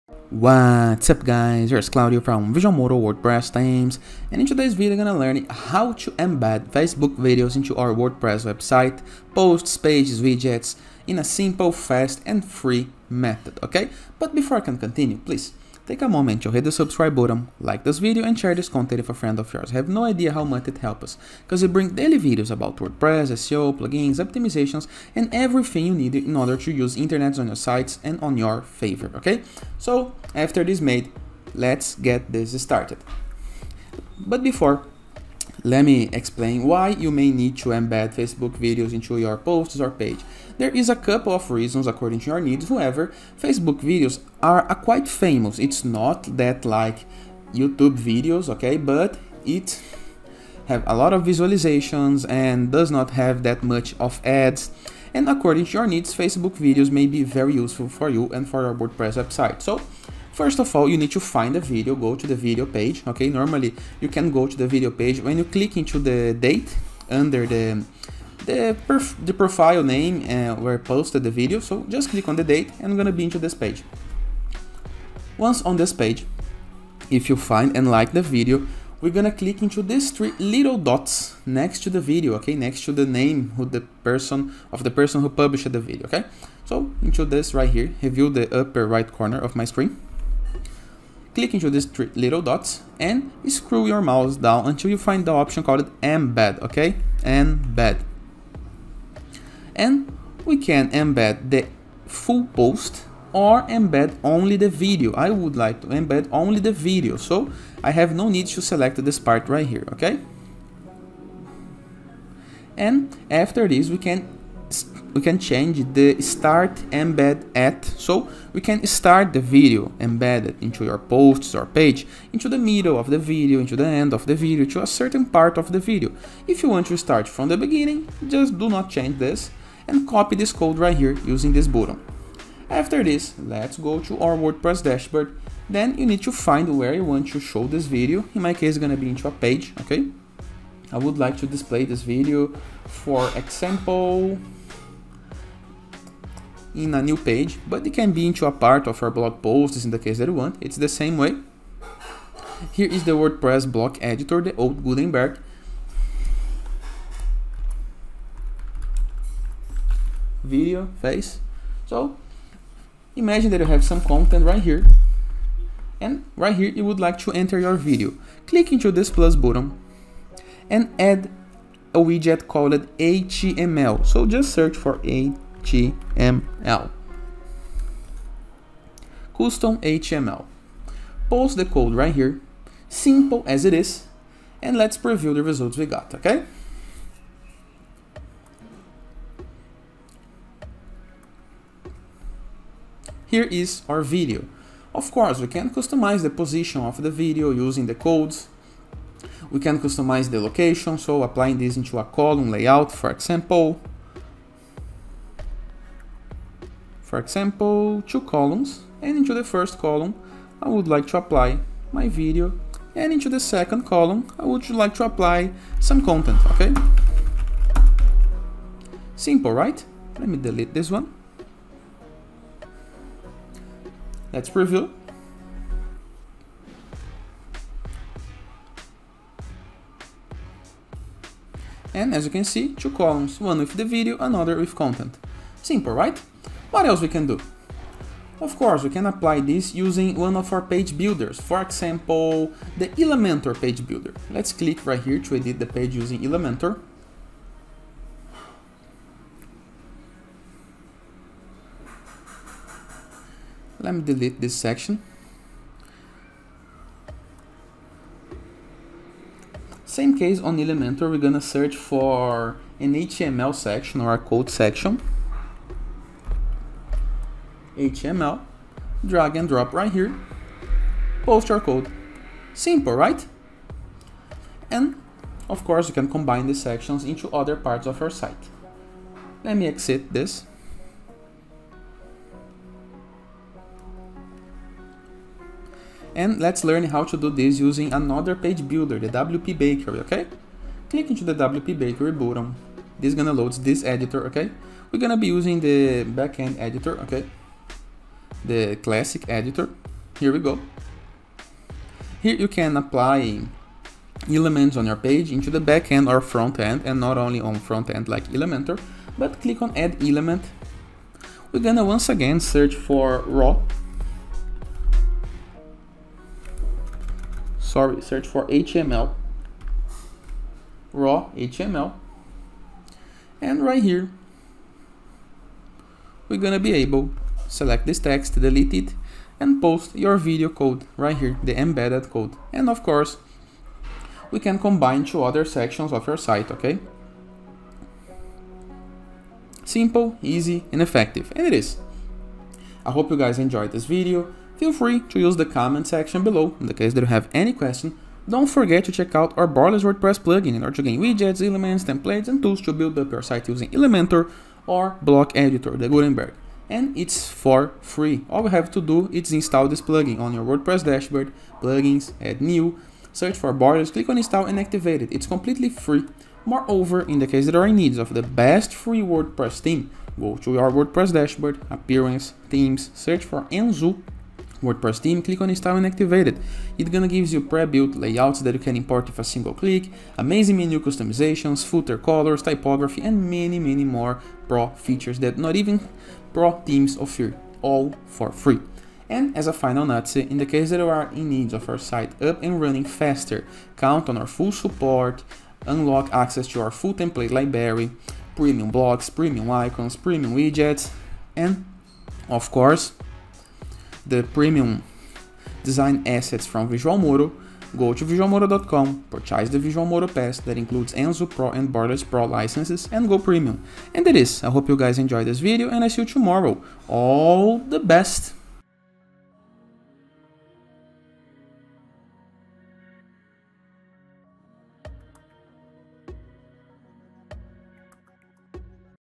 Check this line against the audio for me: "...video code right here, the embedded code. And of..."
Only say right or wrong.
right.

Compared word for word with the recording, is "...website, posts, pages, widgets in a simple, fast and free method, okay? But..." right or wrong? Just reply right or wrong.
right.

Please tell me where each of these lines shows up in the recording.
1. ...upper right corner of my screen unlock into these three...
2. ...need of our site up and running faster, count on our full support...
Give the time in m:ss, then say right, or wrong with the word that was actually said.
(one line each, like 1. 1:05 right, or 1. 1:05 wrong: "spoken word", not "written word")
1. 1:28 wrong: "click", not "unlock"
2. 6:31 right.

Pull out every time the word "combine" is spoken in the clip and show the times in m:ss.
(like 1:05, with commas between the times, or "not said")
4:36, 5:34.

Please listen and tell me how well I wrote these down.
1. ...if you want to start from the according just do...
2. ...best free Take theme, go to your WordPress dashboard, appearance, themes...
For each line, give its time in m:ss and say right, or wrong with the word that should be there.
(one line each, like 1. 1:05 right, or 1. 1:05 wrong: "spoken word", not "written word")
1. 2:06 wrong: "beginning", not "according"
2. 6:08 wrong: "WordPress", not "Take".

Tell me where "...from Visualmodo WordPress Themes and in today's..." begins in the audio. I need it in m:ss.
0:02.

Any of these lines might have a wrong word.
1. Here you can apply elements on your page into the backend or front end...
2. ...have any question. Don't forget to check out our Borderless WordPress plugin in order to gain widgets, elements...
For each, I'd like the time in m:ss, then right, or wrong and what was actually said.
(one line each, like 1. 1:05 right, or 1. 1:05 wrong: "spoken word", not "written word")
1. 5:02 right
2. 5:47 right.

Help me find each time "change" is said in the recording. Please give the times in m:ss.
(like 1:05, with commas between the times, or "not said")
1:55, 2:08.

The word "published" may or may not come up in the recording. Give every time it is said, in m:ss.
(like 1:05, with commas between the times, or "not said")
1:25.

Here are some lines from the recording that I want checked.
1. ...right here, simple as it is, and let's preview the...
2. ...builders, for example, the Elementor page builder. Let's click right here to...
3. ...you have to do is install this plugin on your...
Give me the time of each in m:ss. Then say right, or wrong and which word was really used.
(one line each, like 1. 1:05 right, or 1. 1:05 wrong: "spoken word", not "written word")
1. 3:01 right
2. 4:00 right
3. 5:58 right.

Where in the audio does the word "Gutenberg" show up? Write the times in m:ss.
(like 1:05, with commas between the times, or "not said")
2:34, 5:55.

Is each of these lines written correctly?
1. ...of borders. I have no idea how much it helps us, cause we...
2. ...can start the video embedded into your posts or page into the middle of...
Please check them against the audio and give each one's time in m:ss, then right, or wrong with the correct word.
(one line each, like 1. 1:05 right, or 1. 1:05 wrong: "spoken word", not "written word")
1. 0:19 wrong: "yours", not "borders"
2. 1:58 right.